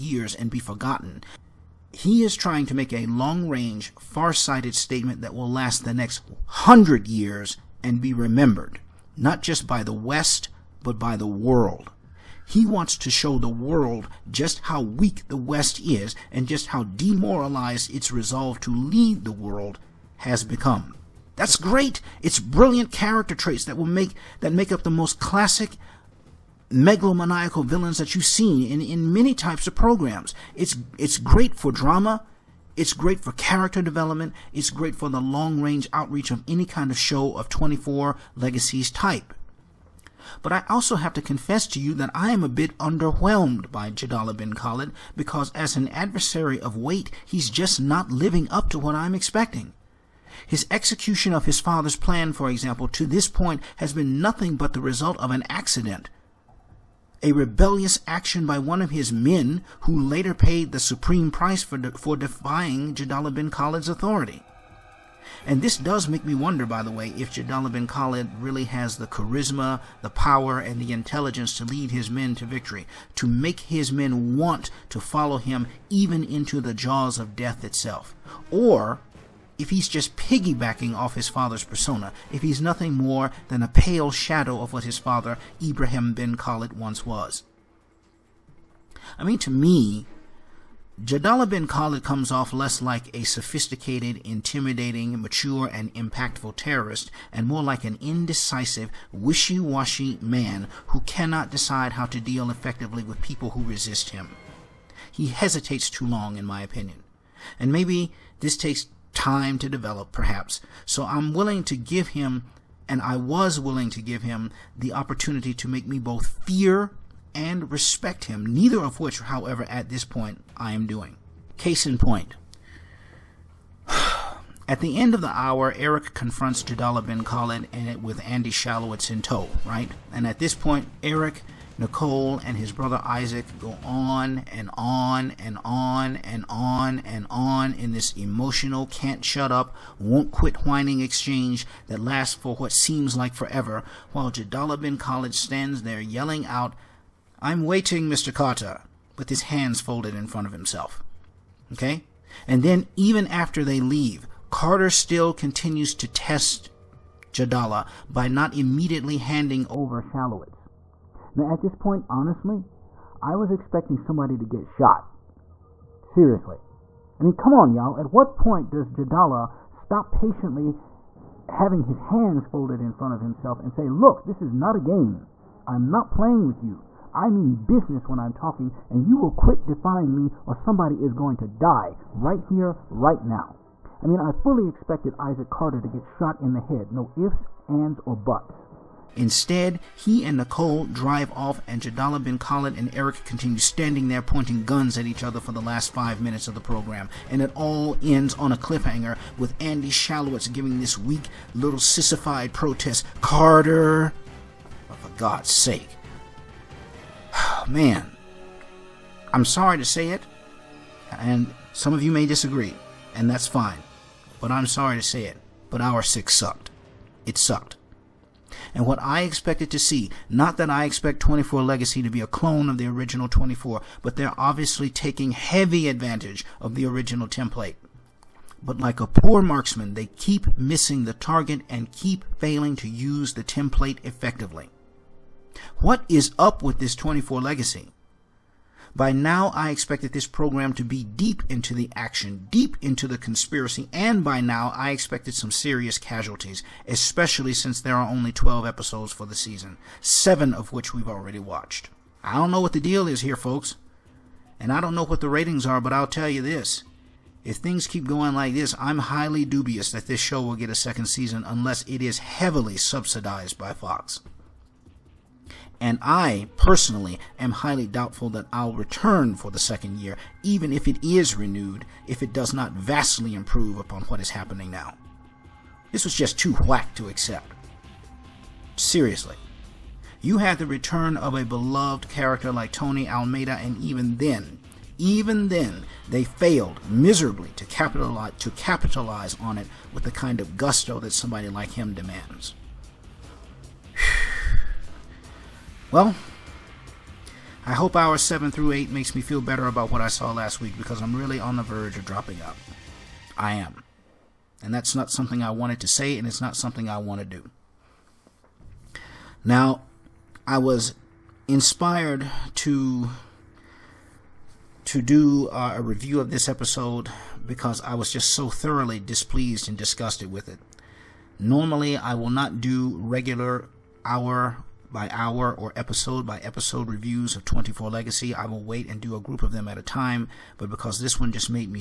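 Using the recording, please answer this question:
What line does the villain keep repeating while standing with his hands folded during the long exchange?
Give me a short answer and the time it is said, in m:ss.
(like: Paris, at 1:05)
I'm waiting, Mr. Carter, at 2:27.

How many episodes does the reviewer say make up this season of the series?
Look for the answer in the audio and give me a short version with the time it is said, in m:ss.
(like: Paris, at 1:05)
12, at 4:08.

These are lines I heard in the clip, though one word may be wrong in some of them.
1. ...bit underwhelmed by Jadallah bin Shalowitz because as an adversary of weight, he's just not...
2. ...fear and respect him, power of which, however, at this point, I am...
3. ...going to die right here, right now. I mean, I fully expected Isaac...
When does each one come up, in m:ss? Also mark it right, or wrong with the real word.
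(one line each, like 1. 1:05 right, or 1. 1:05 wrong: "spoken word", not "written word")
1. 0:42 wrong: "Khalid", not "Shalowitz"
2. 1:56 wrong: "neither", not "power"
3. 3:01 right.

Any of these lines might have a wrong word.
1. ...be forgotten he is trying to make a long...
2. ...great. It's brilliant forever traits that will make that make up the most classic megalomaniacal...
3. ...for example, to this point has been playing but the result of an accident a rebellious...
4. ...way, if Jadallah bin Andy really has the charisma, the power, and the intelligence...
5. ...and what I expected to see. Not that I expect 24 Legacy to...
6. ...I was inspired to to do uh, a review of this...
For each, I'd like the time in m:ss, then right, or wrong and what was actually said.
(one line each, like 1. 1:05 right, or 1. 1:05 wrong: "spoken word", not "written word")
1. 0:00 right
2. 0:21 wrong: "character", not "forever"
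3. 0:52 wrong: "nothing", not "playing"
4. 1:06 wrong: "Khalid", not "Andy"
5. 3:38 right
6. 5:10 right.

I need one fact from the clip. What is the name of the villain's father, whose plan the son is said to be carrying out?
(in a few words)
Ibrahim bin Khalid.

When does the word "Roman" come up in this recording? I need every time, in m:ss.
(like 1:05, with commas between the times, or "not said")
not said.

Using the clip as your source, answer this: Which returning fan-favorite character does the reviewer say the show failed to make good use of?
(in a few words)
Tony Almeida.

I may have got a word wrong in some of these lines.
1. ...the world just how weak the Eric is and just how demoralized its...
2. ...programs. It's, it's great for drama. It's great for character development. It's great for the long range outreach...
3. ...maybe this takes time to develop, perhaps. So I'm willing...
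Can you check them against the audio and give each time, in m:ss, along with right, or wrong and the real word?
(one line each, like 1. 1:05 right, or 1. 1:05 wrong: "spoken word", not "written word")
1. 0:13 wrong: "West", not "Eric"
2. 0:29 right
3. 1:47 right.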